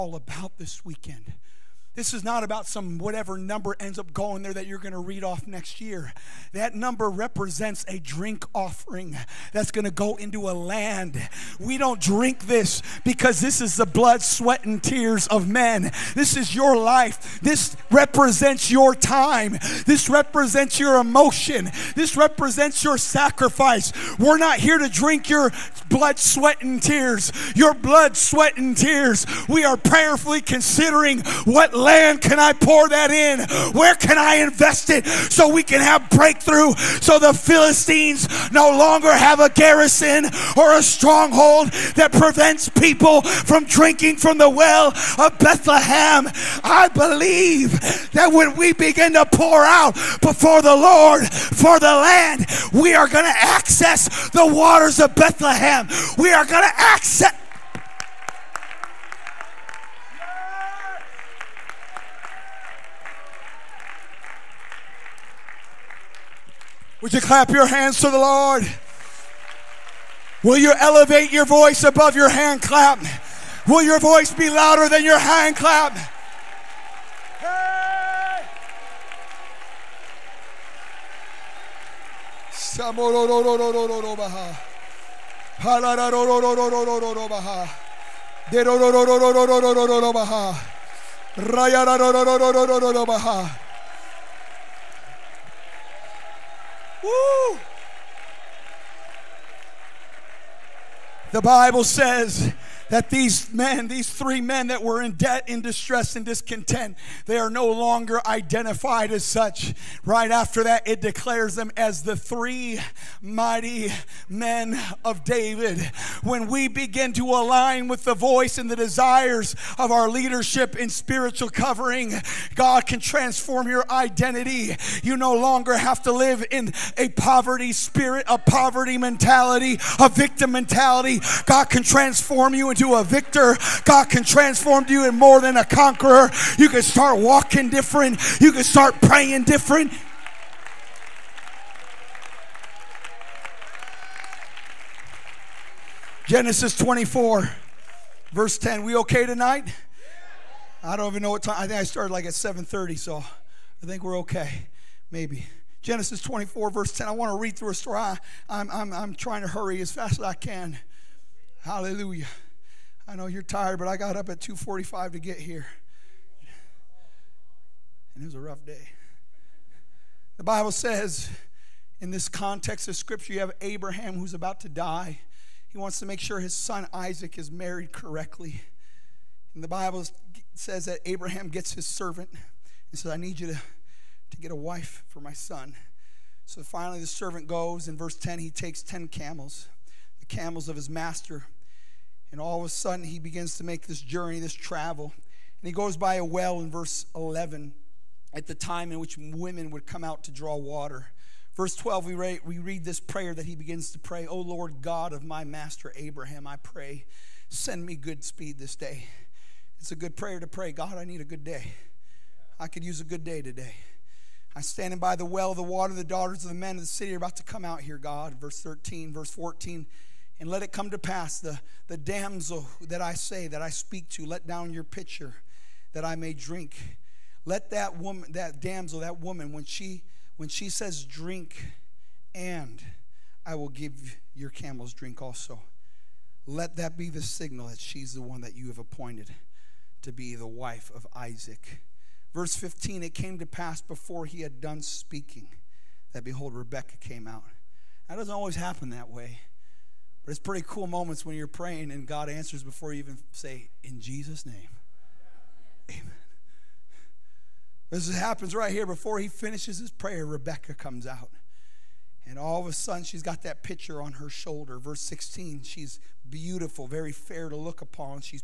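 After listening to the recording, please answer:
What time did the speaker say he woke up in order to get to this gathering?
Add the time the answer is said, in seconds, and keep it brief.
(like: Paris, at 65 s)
2:45, at 164 s.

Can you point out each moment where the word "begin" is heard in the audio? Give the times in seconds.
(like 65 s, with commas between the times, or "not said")
48 s, 116 s, 193 s, 203 s.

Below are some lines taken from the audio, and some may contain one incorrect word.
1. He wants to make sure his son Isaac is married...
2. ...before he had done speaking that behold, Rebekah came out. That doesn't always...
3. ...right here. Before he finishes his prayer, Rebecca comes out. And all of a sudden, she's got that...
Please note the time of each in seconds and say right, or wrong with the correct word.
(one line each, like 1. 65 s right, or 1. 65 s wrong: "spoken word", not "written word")
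1. 175 s right
2. 243 s right
3. 258 s right.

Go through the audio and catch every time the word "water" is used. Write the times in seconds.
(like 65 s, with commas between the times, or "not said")
54 s, 200 s, 215 s.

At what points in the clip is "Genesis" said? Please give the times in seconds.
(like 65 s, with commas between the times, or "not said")
146 s, 155 s.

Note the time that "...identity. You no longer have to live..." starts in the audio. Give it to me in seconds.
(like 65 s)
123 s.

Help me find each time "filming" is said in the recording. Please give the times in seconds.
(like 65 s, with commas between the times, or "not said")
not said.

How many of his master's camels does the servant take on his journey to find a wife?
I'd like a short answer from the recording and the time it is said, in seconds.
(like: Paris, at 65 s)
10, at 188 s.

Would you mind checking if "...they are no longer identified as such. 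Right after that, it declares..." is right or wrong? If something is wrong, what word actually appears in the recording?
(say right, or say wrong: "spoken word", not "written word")
right.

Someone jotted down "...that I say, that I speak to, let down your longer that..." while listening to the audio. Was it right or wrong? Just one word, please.
wrong.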